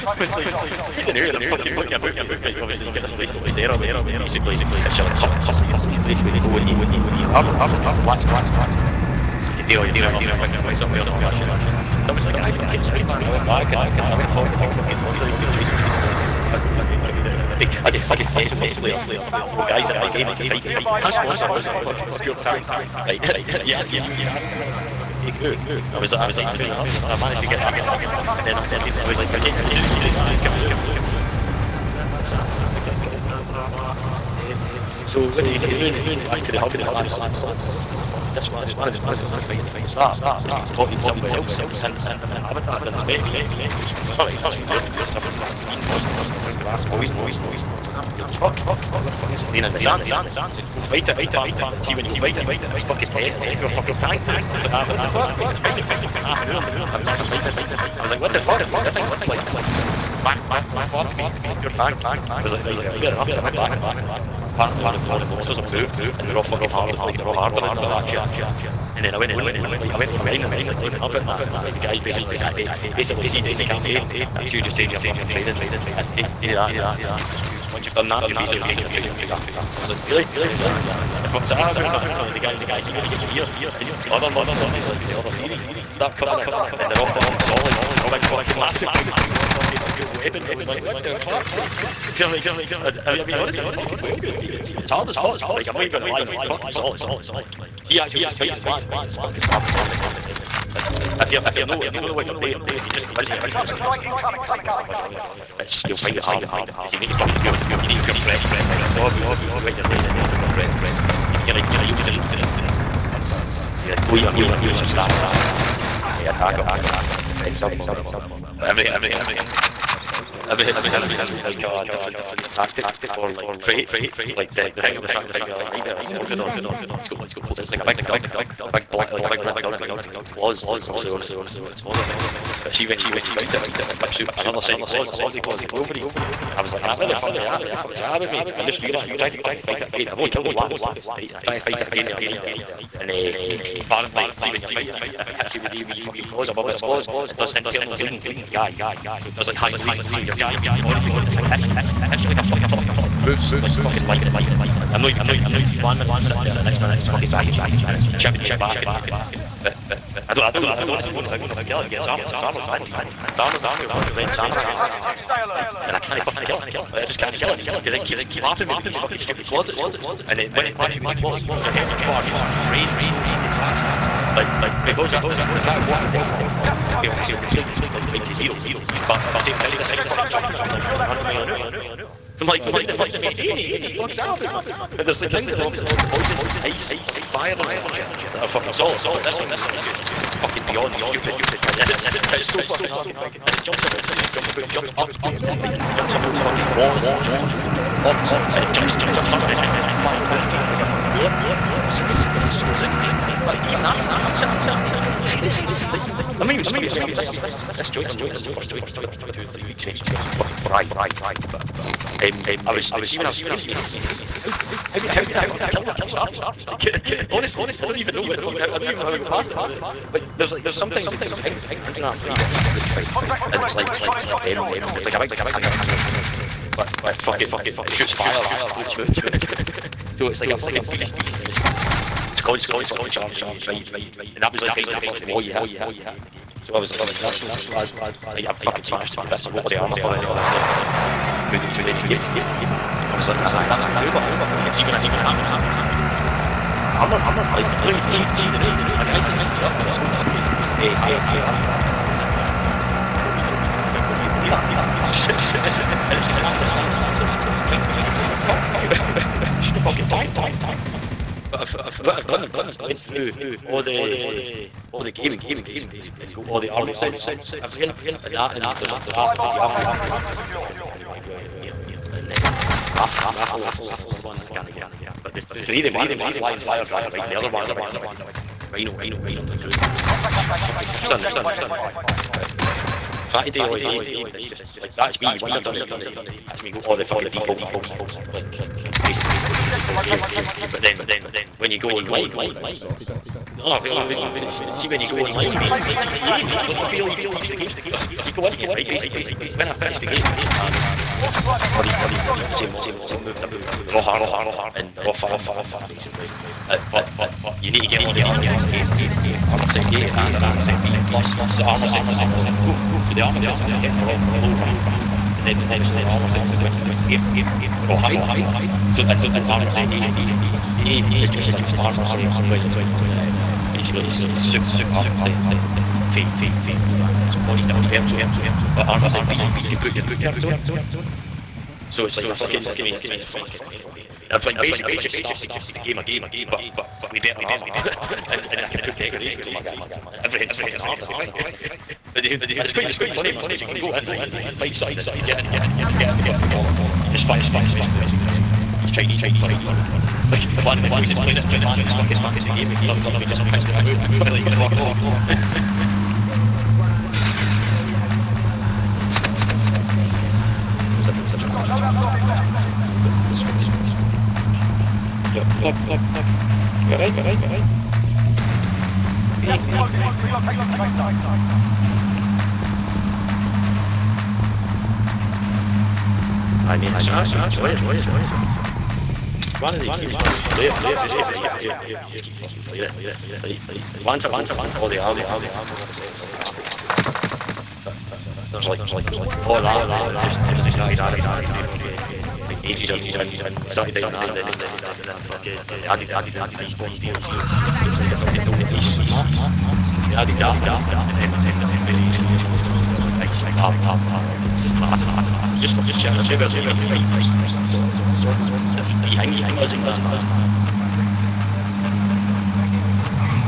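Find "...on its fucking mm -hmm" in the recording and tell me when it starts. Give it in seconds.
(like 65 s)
131 s.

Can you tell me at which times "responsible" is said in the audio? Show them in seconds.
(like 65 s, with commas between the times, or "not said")
not said.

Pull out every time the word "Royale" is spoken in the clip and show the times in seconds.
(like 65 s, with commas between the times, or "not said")
19 s.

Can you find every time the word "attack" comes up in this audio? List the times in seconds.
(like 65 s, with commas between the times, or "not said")
116 s.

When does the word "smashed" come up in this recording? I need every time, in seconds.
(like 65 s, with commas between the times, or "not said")
238 s.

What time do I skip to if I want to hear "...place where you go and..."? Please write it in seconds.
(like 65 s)
6 s.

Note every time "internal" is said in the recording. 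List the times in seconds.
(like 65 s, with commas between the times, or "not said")
147 s.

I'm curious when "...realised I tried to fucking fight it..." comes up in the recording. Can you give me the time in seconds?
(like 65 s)
138 s.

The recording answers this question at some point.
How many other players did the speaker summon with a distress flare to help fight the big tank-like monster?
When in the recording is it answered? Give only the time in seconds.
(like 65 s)
19 s.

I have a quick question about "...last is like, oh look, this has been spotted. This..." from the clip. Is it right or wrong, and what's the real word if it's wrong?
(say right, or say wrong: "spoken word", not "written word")
right.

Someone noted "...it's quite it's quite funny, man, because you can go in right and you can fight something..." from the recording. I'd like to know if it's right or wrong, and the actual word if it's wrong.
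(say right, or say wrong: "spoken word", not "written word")
right.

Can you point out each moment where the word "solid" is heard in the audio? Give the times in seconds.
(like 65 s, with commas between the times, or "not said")
87 s, 96 s, 188 s.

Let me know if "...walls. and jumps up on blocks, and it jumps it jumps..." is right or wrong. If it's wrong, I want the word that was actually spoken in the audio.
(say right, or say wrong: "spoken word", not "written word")
right.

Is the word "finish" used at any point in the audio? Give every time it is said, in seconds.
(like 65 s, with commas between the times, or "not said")
299 s, 316 s.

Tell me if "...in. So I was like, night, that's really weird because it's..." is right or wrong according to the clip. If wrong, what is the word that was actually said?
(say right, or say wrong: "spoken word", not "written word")
wrong: "alright", not "night".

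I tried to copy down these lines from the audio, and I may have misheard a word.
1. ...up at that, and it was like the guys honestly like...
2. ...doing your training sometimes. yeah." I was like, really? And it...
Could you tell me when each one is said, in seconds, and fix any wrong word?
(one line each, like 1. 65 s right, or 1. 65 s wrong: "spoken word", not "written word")
1. 71 s wrong: "basically", not "honestly"
2. 78 s wrong: "moves", not "sometimes".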